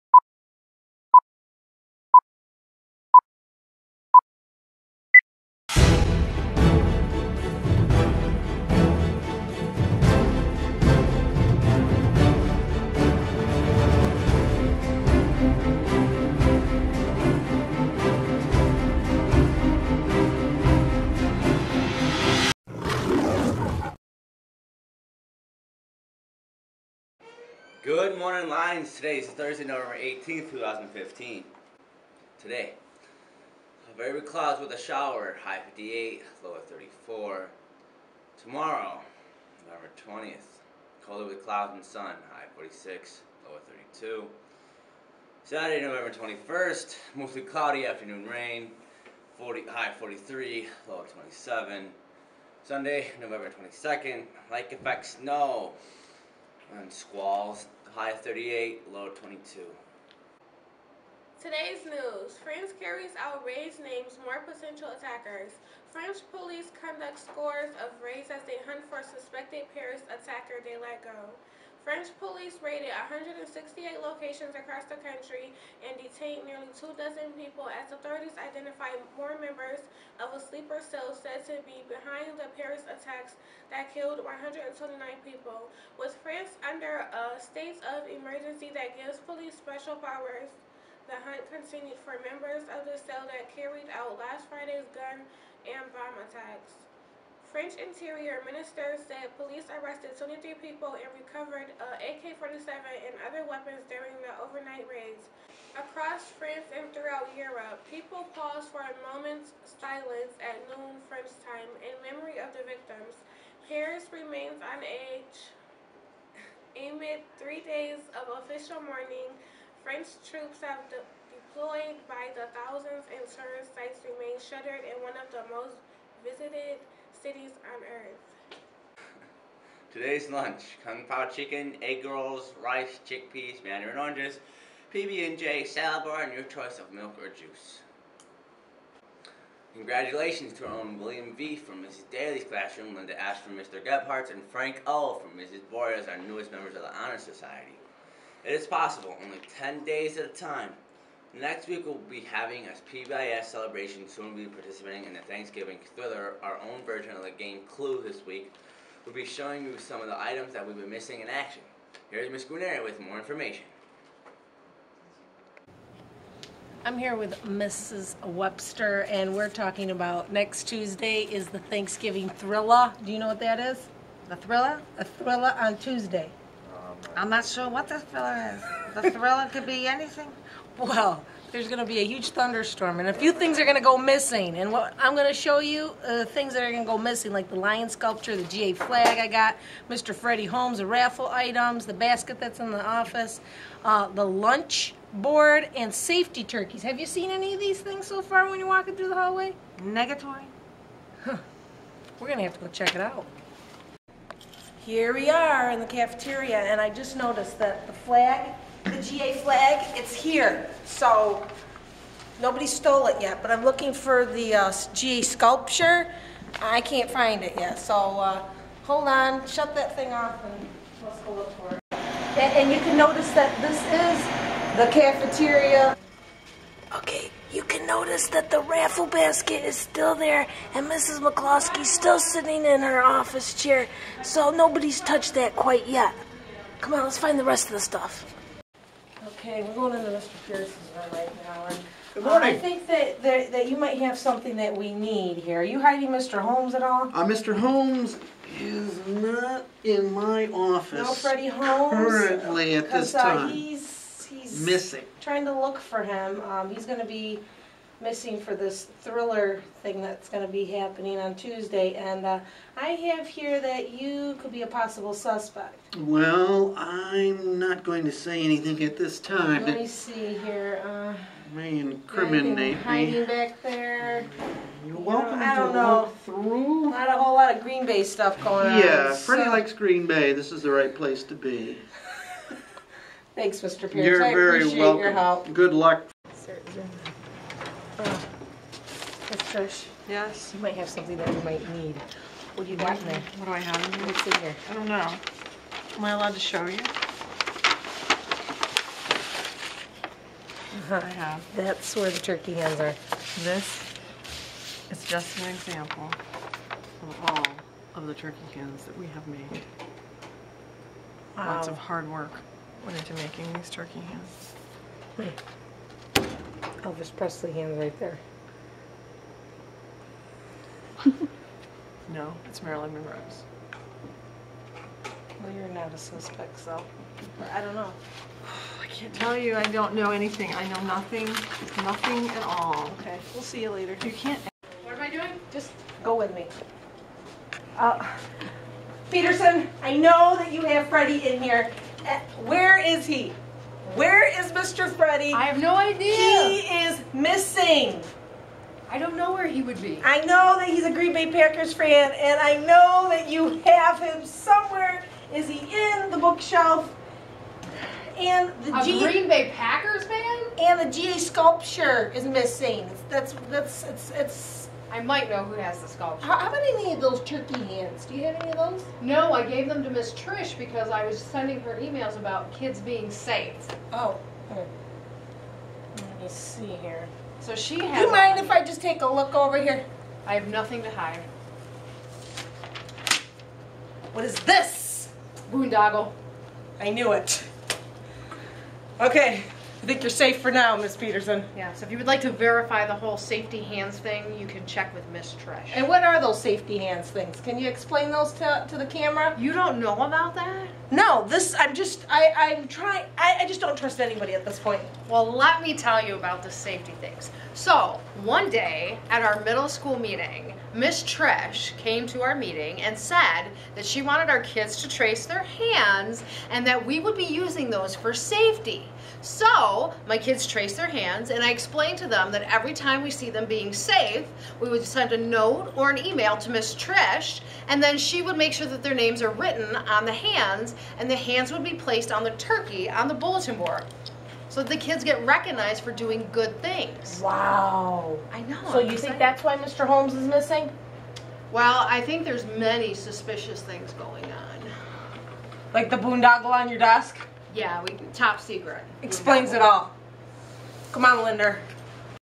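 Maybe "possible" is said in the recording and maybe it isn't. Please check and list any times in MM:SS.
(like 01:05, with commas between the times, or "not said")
02:28, 04:24.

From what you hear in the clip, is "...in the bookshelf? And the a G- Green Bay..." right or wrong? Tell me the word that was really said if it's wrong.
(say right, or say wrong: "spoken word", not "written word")
right.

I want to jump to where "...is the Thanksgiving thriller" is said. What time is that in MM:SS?
02:51.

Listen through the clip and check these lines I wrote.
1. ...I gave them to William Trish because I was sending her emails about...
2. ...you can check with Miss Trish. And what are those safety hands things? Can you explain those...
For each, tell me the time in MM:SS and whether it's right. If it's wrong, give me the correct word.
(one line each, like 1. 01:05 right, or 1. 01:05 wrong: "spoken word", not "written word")
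1. 06:09 wrong: "Miss", not "William"
2. 06:34 right.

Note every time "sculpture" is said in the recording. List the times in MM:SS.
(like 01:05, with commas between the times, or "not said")
03:07, 03:35, 06:01, 06:05.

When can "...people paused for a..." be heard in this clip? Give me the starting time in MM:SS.
01:47.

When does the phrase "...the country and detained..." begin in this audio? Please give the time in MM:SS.
01:14.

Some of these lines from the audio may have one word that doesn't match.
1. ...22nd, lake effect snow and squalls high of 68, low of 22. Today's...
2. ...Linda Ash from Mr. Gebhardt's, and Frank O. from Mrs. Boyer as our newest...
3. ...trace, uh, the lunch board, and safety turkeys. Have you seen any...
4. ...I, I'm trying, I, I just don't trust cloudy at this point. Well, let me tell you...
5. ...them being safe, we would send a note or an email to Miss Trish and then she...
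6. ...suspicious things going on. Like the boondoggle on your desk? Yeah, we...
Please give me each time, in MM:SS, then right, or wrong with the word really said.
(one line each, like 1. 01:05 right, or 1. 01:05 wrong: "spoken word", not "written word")
1. 00:53 wrong: "38", not "68"
2. 02:22 right
3. 03:12 wrong: "office", not "trace"
4. 06:42 wrong: "anybody", not "cloudy"
5. 07:03 right
6. 07:22 right.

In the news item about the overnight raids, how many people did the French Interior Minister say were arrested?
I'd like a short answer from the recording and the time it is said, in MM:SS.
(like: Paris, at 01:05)
23, at 01:40.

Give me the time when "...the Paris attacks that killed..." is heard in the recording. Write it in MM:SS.
01:22.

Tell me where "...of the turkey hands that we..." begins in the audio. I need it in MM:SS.
05:07.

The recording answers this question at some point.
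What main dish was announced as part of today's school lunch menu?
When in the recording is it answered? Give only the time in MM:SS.
02:10.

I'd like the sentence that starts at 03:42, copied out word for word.
And, and you can notice that this is the cafeteria.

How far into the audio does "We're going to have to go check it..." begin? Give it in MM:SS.
03:22.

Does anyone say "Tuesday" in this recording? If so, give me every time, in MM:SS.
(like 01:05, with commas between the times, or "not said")
02:50, 02:55, 04:21.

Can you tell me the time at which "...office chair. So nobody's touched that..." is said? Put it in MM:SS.
03:53.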